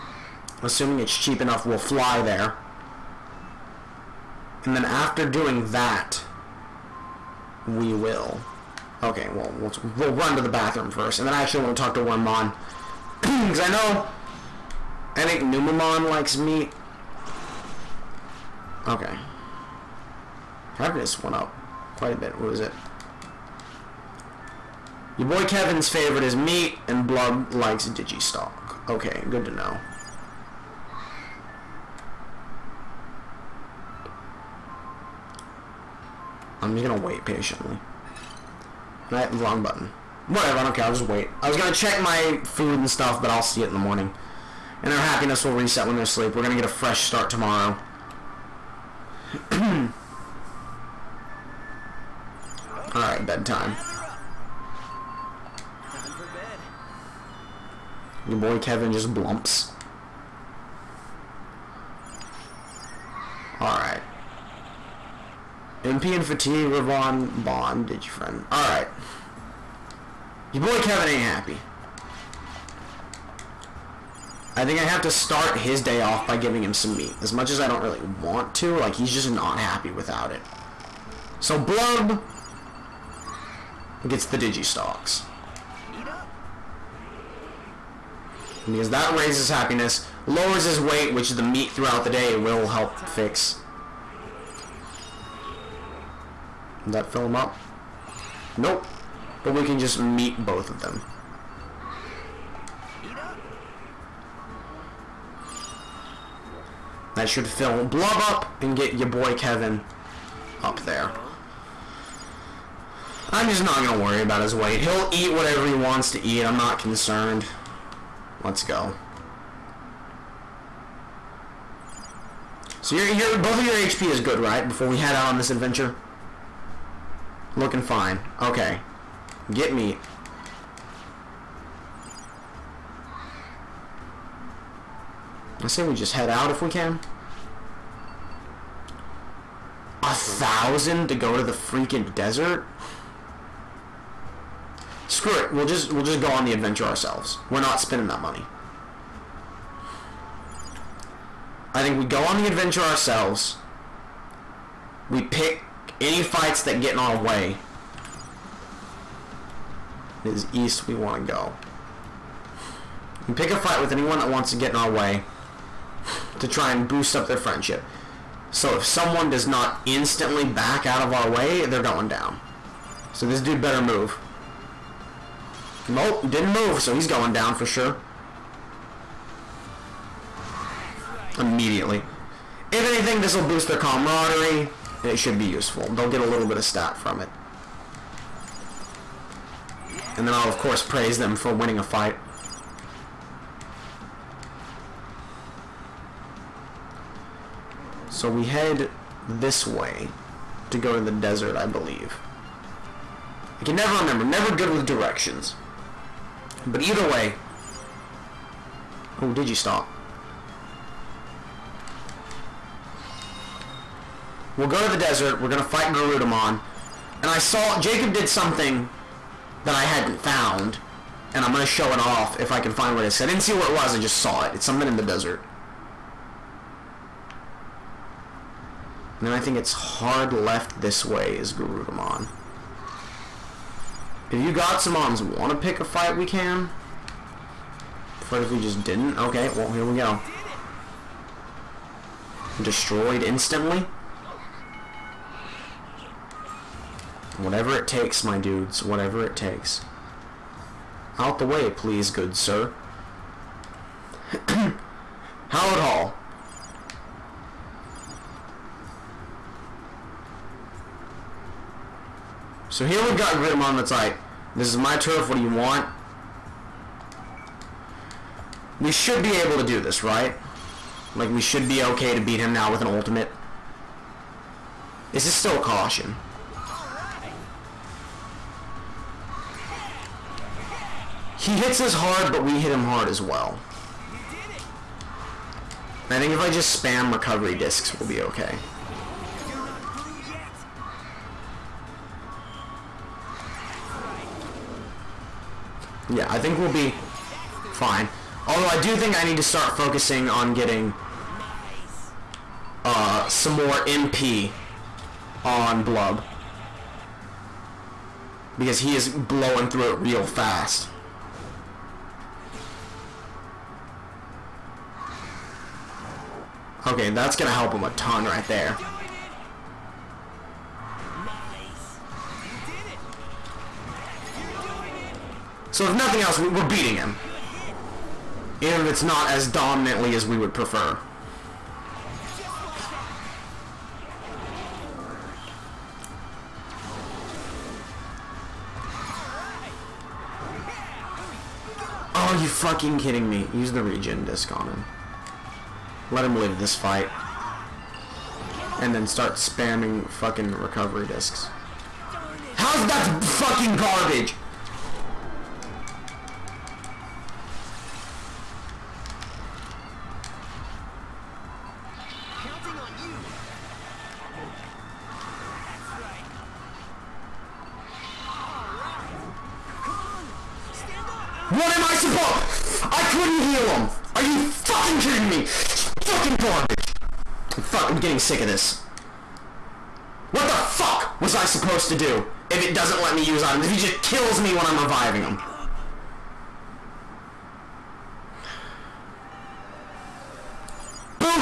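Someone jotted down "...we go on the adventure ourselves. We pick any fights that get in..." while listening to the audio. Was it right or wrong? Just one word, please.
right.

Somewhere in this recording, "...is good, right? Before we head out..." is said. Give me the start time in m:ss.
2:04.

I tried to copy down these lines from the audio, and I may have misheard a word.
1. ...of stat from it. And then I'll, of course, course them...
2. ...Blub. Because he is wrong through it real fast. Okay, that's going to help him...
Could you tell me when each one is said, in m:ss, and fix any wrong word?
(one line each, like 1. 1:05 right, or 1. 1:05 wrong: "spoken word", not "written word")
1. 3:06 wrong: "praise", not "course"
2. 5:05 wrong: "blowing", not "wrong".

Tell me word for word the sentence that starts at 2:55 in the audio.
Nope, didn't move, so he's going down for sure.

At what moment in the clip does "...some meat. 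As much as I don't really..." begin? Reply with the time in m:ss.
1:16.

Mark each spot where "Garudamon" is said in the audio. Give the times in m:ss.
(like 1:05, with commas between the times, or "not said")
3:35, 3:51.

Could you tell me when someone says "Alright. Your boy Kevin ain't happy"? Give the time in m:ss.
1:08.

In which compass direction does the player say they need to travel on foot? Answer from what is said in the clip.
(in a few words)
East.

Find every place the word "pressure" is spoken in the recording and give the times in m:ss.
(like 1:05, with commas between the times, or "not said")
not said.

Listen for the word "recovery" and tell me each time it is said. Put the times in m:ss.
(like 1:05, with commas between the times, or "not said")
4:47, 5:50.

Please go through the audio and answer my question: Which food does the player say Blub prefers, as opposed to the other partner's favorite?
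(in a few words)
DigiStock.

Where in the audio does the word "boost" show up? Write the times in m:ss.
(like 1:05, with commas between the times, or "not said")
2:46, 3:03.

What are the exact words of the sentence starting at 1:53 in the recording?
I'm just not going to worry about his weight.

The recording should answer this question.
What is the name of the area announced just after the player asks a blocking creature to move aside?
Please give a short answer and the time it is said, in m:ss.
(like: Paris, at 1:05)
Hallowed Hall, at 4:15.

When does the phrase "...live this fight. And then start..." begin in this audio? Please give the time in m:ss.
5:46.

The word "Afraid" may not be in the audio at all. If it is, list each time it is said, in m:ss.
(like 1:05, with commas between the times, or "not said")
3:58.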